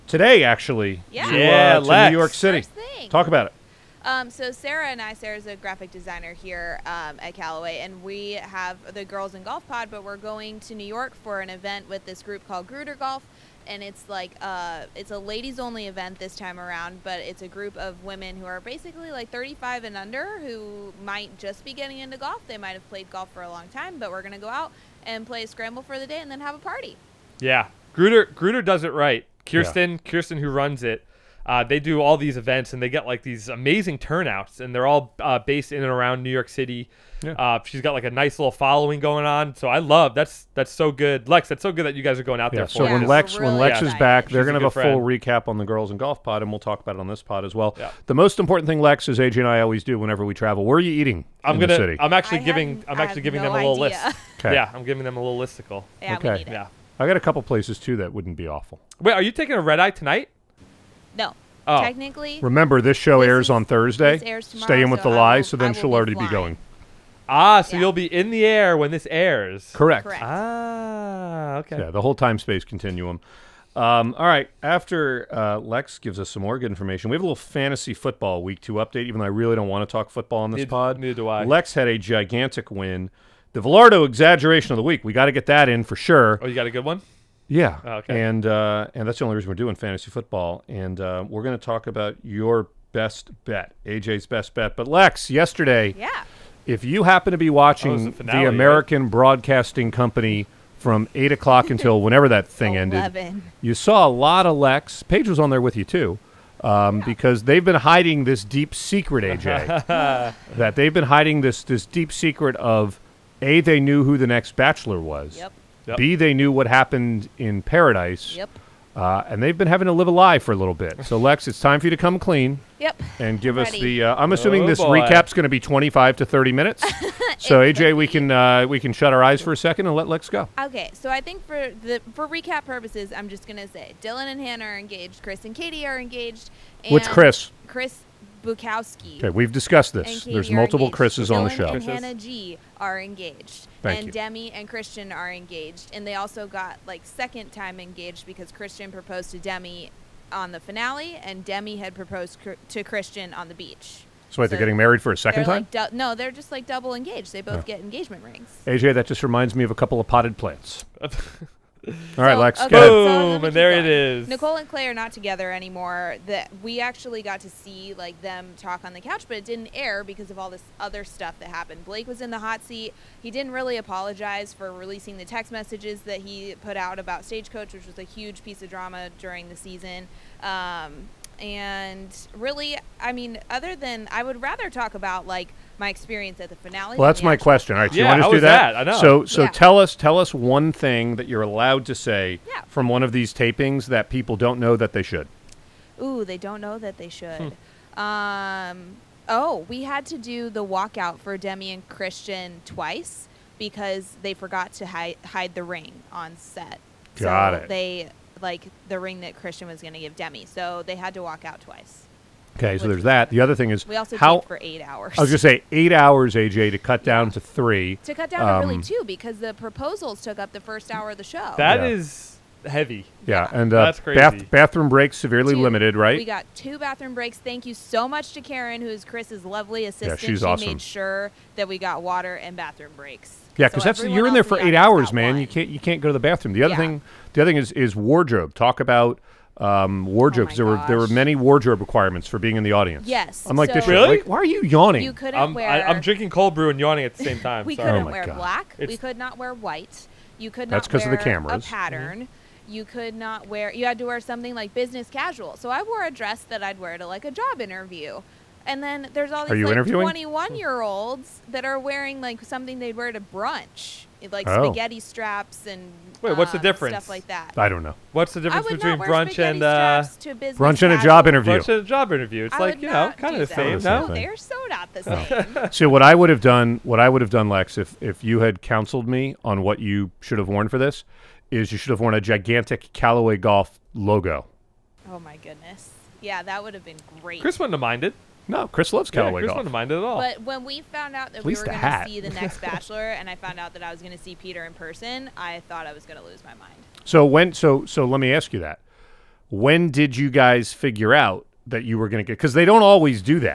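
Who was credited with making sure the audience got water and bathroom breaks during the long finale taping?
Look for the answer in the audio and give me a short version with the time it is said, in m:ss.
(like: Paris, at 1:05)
Karen, at 3:48.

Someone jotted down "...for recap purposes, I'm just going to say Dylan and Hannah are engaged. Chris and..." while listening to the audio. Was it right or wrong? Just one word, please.
right.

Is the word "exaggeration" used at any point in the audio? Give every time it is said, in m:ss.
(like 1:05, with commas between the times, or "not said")
1:24.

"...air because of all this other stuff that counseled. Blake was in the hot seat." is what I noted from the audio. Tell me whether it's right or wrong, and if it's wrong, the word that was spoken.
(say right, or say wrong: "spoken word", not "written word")
wrong: "happened", not "counseled".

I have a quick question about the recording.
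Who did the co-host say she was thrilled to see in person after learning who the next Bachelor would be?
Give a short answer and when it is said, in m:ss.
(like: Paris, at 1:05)
Peter, at 4:54.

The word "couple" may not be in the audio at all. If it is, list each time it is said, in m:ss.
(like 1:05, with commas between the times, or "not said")
0:57, 2:39.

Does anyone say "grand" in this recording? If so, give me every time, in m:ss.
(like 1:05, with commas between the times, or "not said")
not said.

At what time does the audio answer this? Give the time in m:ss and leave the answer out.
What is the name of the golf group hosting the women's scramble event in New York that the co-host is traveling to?
0:12.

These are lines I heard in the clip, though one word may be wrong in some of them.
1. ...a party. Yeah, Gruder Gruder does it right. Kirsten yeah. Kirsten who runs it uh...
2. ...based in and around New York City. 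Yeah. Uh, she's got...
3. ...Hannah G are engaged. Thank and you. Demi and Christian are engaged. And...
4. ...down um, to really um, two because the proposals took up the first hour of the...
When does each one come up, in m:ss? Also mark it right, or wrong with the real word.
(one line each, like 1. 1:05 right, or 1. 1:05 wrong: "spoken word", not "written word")
1. 0:26 right
2. 0:35 right
3. 2:21 right
4. 3:38 right.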